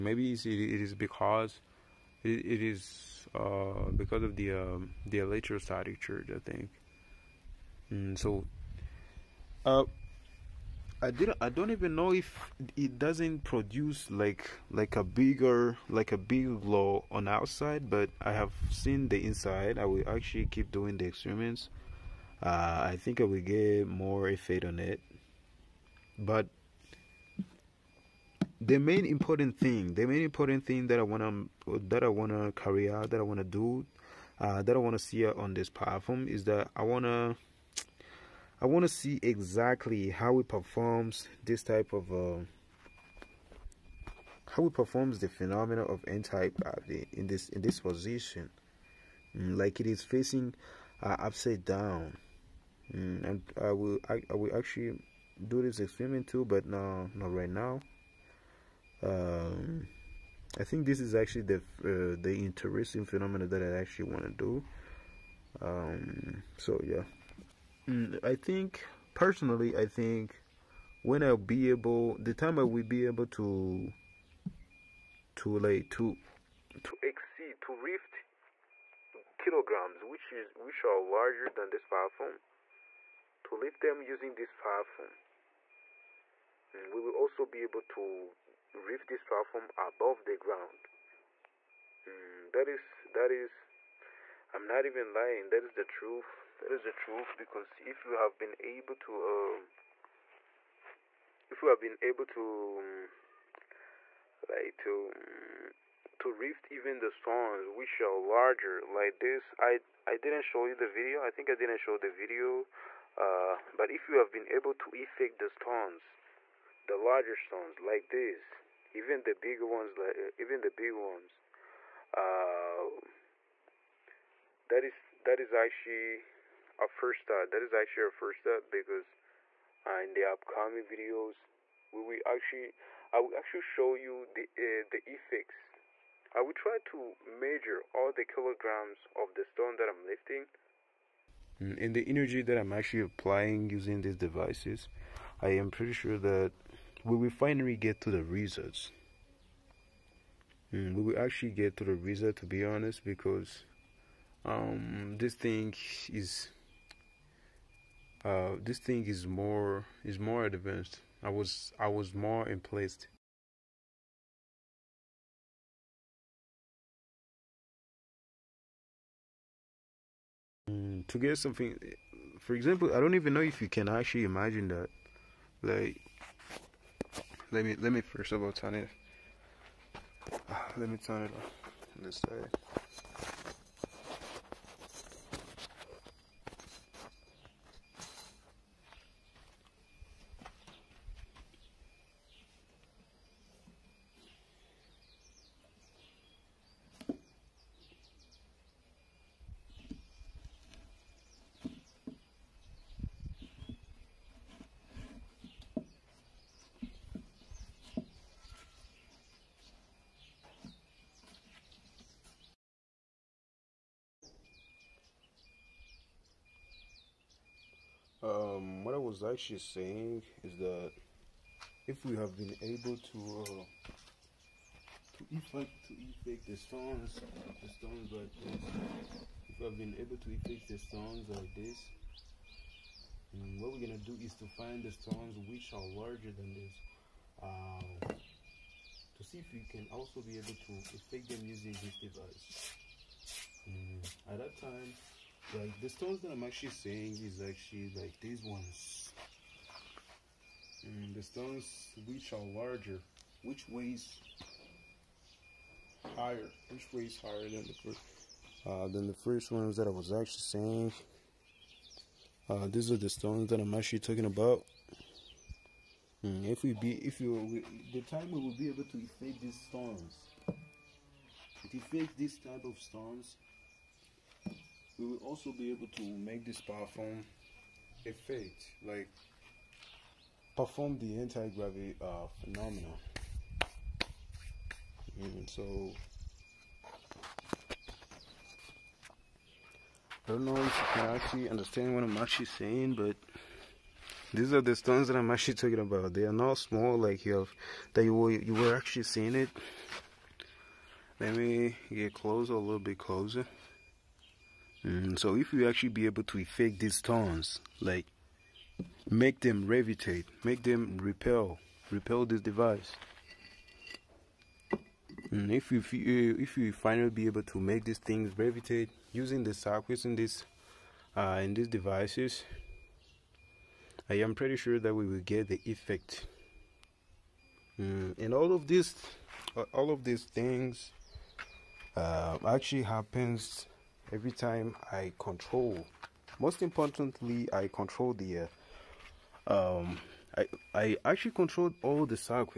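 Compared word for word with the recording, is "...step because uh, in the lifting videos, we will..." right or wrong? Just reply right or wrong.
wrong.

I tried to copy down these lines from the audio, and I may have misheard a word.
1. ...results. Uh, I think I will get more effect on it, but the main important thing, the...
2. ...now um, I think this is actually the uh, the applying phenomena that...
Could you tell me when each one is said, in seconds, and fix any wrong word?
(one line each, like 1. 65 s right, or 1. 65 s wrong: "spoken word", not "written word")
1. 21 s wrong: "experiments", not "results"
2. 57 s wrong: "interesting", not "applying".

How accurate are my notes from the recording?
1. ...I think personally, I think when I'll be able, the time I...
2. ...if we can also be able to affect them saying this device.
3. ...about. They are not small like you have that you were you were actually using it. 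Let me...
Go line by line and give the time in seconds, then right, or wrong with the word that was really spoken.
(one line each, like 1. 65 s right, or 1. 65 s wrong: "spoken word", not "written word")
1. 68 s right
2. 239 s wrong: "using", not "saying"
3. 295 s wrong: "seeing", not "using".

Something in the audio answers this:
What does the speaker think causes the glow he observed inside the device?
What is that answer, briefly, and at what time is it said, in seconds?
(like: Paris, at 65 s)
electrostatic charge, at 5 s.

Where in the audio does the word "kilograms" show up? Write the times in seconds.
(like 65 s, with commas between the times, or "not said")
79 s, 138 s.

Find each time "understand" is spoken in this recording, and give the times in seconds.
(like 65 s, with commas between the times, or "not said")
291 s.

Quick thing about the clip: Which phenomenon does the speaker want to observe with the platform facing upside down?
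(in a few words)
n-type.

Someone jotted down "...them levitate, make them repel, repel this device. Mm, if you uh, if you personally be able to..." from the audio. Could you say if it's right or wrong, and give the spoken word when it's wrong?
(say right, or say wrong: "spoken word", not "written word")
wrong: "finally", not "personally".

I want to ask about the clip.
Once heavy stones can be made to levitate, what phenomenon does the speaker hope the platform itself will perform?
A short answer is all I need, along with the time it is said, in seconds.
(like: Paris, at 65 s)
anti-gravity, at 281 s.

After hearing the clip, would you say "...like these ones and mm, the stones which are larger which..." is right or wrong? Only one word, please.
right.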